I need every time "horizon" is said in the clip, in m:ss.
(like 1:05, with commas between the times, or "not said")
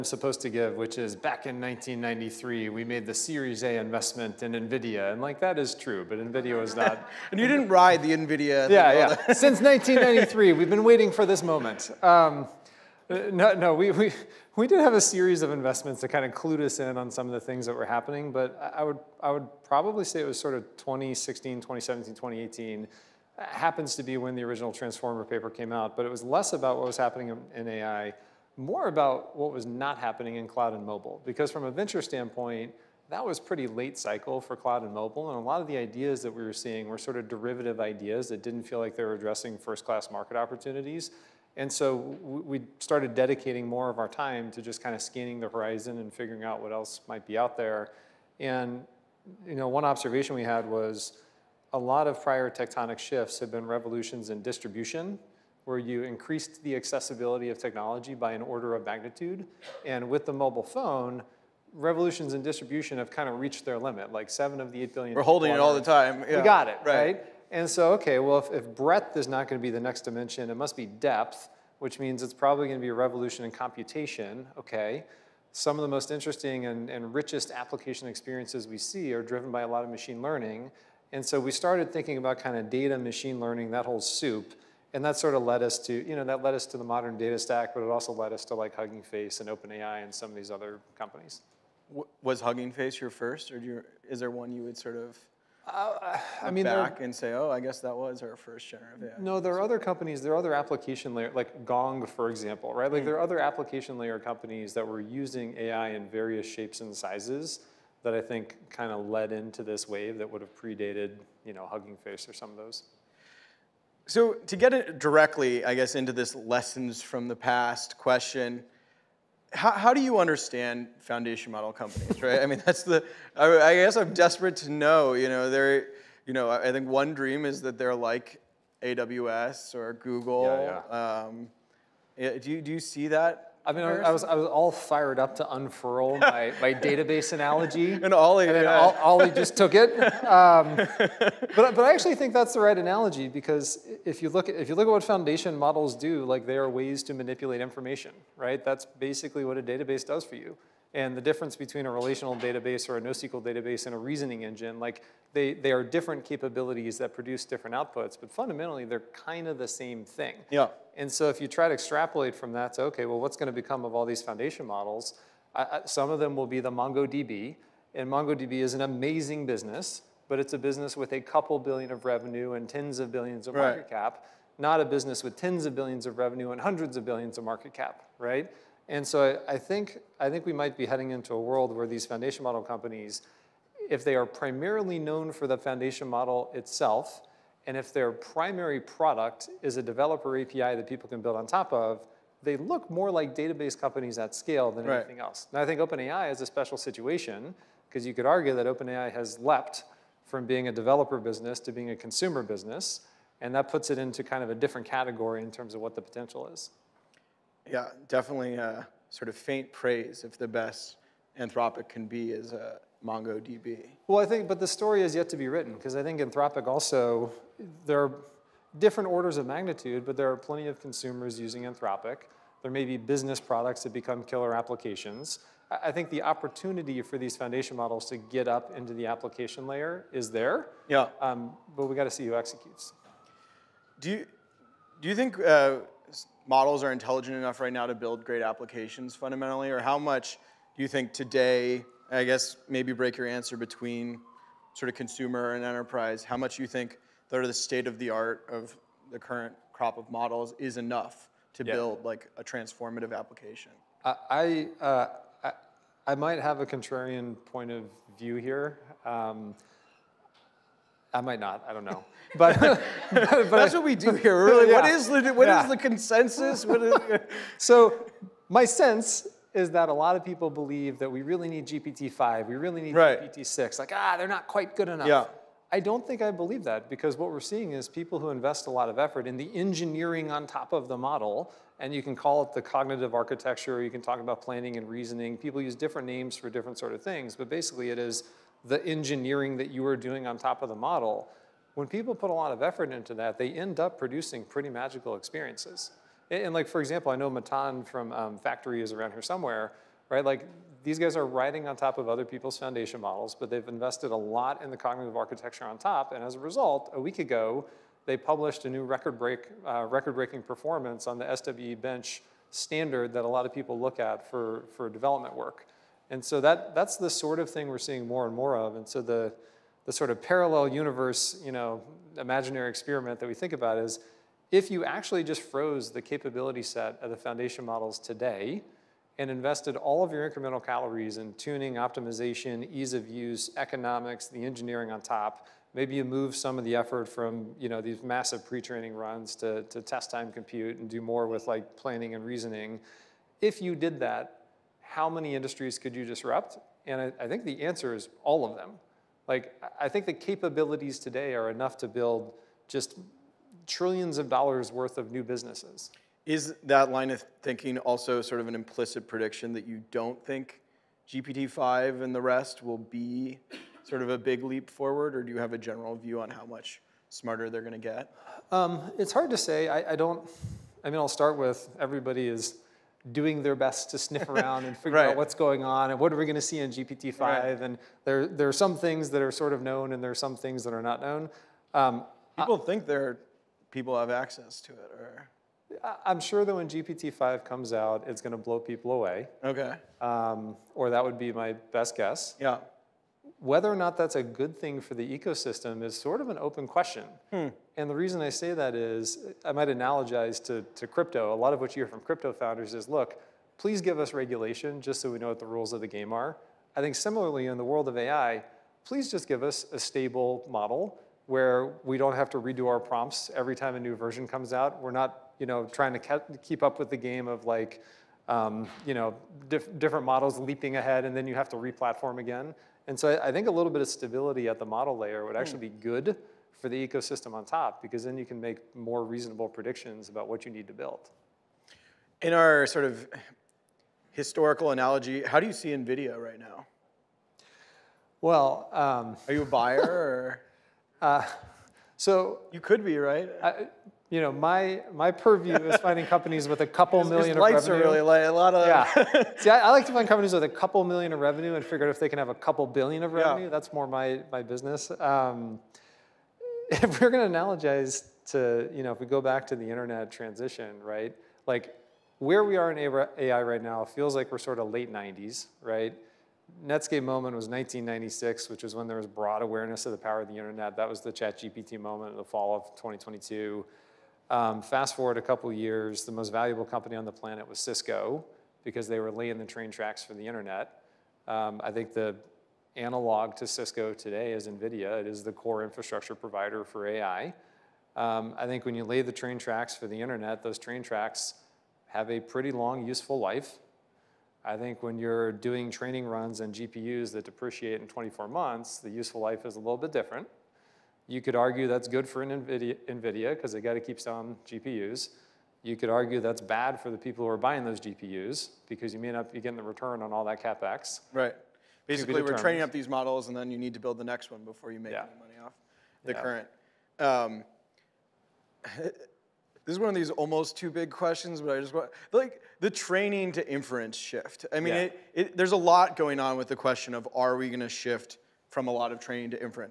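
0:45.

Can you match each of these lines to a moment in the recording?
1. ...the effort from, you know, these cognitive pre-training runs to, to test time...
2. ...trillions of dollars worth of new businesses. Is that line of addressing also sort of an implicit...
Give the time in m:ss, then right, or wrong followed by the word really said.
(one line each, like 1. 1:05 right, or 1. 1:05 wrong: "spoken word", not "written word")
1. 5:36 wrong: "massive", not "cognitive"
2. 5:53 wrong: "thinking", not "addressing".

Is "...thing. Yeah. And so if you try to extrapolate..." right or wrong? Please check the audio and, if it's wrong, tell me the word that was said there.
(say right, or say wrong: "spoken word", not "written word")
right.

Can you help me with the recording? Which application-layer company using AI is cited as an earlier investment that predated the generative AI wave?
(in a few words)
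Gong.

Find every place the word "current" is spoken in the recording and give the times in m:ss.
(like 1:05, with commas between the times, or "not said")
4:09, 8:36.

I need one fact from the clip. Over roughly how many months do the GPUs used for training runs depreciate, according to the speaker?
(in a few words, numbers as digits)
24 months.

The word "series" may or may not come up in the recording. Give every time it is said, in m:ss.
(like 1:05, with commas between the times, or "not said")
0:03, 0:15.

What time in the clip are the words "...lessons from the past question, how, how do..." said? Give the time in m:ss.
1:56.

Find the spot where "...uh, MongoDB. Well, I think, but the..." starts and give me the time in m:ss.
3:32.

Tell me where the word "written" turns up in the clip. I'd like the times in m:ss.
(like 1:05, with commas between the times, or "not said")
3:35.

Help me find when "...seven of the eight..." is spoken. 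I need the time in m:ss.
1:04.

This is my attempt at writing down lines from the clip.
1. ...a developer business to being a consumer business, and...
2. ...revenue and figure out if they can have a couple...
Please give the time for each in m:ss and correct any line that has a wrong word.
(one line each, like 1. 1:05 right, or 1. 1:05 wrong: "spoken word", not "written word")
1. 3:20 right
2. 7:31 right.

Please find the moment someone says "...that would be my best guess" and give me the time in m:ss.
6:30.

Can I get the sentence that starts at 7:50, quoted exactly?
That was the ChatGPT moment, in the fall of 2022.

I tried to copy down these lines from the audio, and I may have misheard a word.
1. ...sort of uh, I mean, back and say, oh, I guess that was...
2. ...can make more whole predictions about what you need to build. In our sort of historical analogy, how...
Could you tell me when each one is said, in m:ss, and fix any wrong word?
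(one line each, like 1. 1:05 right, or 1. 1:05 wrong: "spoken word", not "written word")
1. 1:34 right
2. 7:08 wrong: "reasonable", not "whole".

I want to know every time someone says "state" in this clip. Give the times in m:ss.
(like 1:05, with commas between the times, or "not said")
4:07.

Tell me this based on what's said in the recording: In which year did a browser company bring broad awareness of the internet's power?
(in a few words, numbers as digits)
1996.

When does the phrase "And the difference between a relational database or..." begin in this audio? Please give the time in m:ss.
2:30.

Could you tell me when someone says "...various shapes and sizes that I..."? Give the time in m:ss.
1:46.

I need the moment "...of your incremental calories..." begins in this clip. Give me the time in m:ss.
5:30.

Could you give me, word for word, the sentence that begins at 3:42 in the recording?
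There may be business products that become killer applications.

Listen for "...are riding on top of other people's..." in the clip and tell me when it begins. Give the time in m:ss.
5:01.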